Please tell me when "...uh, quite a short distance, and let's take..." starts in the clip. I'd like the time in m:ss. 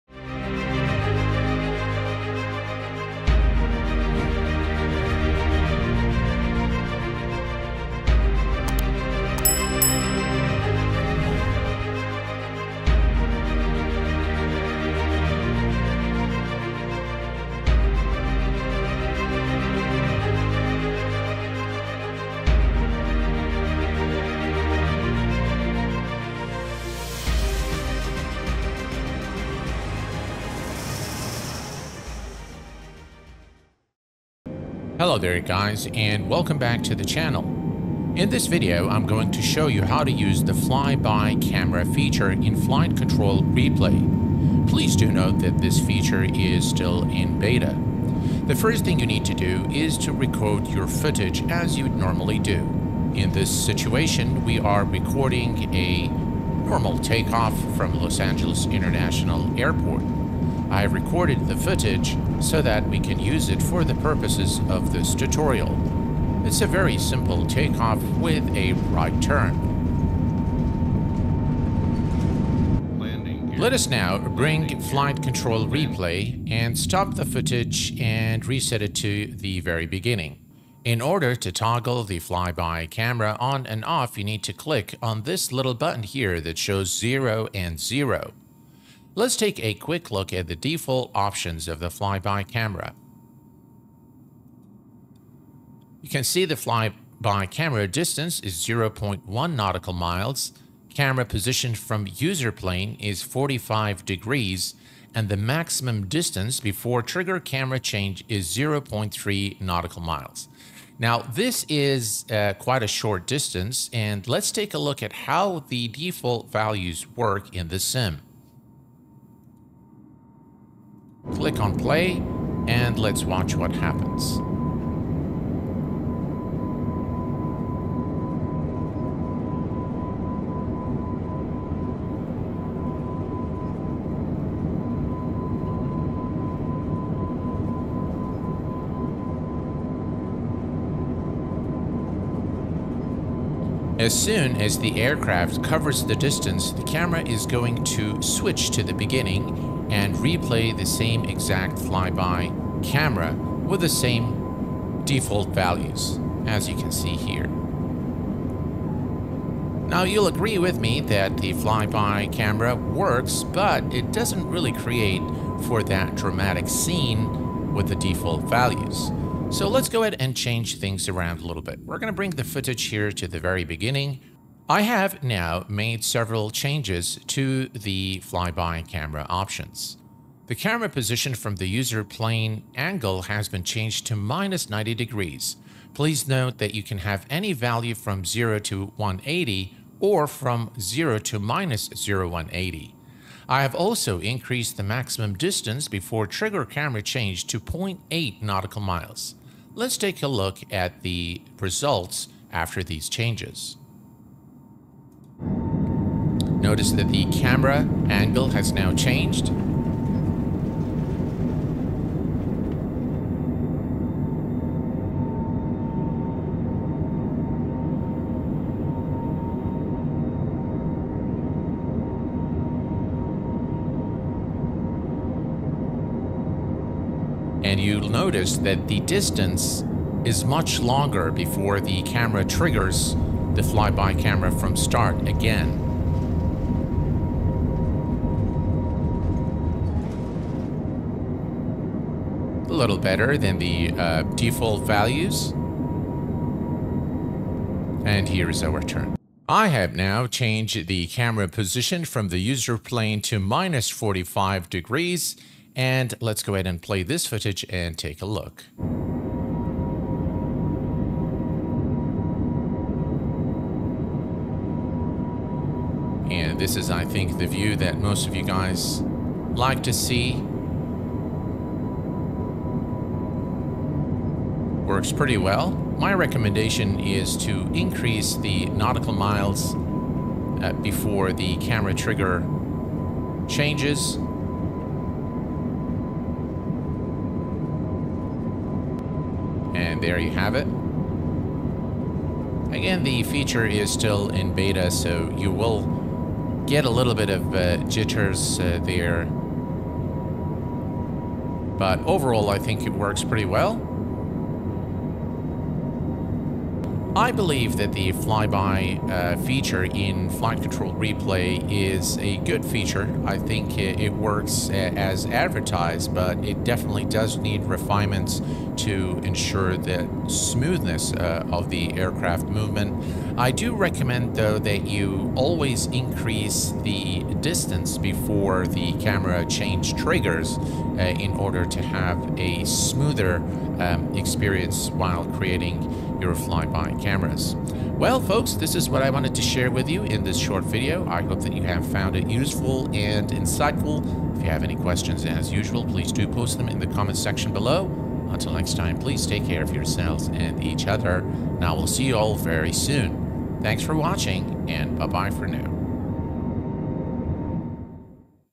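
1:52.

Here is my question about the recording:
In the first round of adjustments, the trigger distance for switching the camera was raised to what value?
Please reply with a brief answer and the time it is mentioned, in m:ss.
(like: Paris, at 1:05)
0.8 nautical miles, at 3:17.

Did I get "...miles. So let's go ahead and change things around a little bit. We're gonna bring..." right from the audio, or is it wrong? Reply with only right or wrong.
wrong.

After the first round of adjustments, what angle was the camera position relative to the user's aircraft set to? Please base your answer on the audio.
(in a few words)
-90 degrees.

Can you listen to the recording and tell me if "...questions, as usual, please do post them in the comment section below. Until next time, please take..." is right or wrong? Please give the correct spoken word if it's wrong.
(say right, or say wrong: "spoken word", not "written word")
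right.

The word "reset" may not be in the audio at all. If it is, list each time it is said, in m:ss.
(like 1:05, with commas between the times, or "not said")
1:18.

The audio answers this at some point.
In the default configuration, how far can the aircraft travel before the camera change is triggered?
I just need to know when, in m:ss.
1:48.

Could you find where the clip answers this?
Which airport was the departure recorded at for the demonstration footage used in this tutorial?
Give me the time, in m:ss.
0:57.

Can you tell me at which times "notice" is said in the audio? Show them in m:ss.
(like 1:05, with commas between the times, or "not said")
3:26, 3:48.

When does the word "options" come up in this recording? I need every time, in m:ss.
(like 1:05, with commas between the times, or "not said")
1:31, 2:59.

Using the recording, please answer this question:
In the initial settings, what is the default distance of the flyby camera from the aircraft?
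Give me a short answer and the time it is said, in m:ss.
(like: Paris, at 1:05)
0.1 nautical miles, at 1:38.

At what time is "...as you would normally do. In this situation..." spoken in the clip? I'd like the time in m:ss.
0:51.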